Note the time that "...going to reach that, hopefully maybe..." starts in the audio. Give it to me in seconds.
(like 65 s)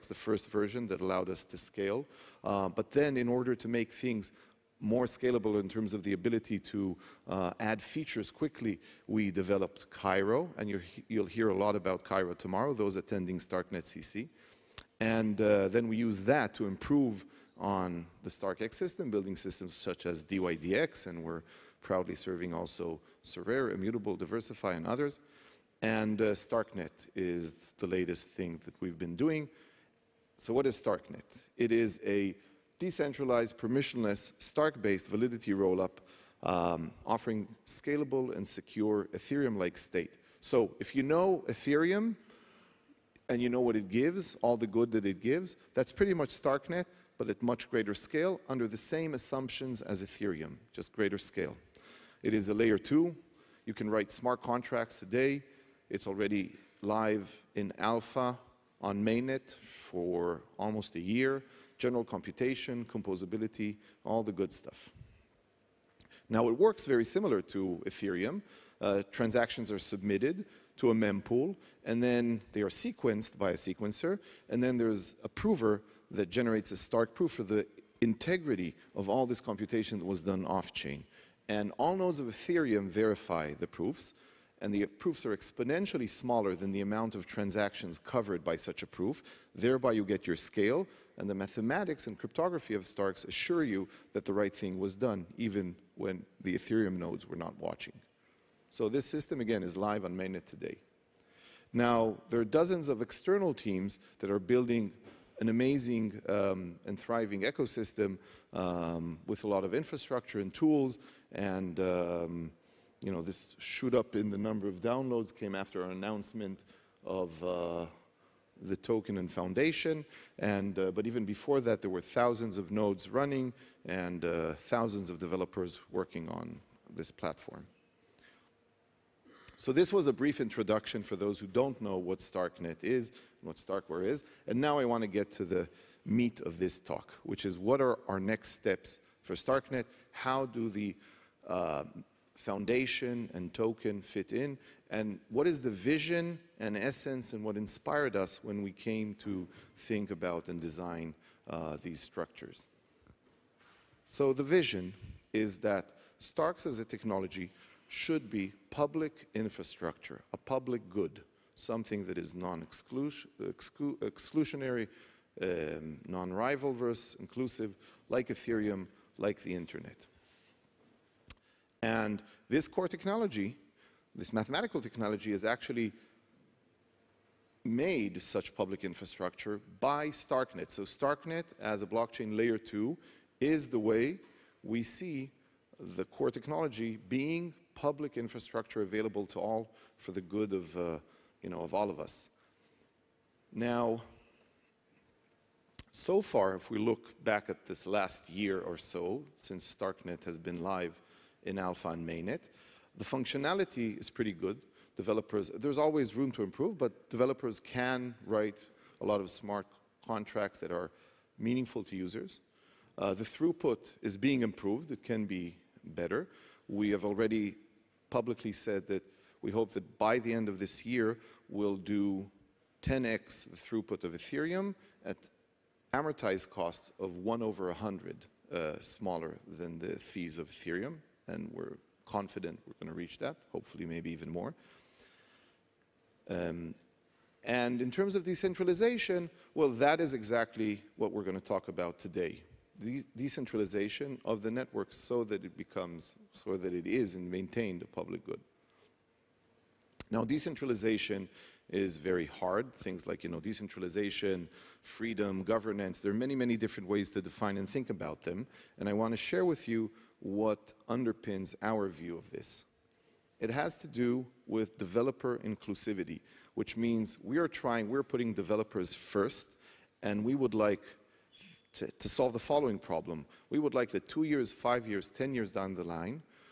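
232 s.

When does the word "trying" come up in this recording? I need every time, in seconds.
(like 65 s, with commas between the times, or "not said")
267 s.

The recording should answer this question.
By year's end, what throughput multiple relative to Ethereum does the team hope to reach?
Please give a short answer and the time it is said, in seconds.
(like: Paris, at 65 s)
10x, at 222 s.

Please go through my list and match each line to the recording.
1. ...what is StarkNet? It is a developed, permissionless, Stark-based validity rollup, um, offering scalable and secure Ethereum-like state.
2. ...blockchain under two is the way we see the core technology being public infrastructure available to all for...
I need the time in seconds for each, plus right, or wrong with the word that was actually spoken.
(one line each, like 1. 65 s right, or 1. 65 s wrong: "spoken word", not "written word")
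1. 30 s wrong: "decentralized", not "developed"
2. 181 s wrong: "layer", not "under".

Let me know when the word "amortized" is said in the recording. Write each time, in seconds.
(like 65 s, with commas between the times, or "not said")
225 s.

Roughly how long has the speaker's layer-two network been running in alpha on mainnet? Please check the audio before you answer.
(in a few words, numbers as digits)
almost a year.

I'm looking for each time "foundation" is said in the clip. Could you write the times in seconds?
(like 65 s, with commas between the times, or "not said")
119 s, 142 s.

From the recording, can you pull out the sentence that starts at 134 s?
And now I want to get to the meat of this talk, which is what are our next steps for StarkNet?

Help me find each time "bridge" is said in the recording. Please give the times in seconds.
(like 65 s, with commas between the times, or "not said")
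not said.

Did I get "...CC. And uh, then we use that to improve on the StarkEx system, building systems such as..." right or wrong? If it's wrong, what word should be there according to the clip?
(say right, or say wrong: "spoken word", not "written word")
right.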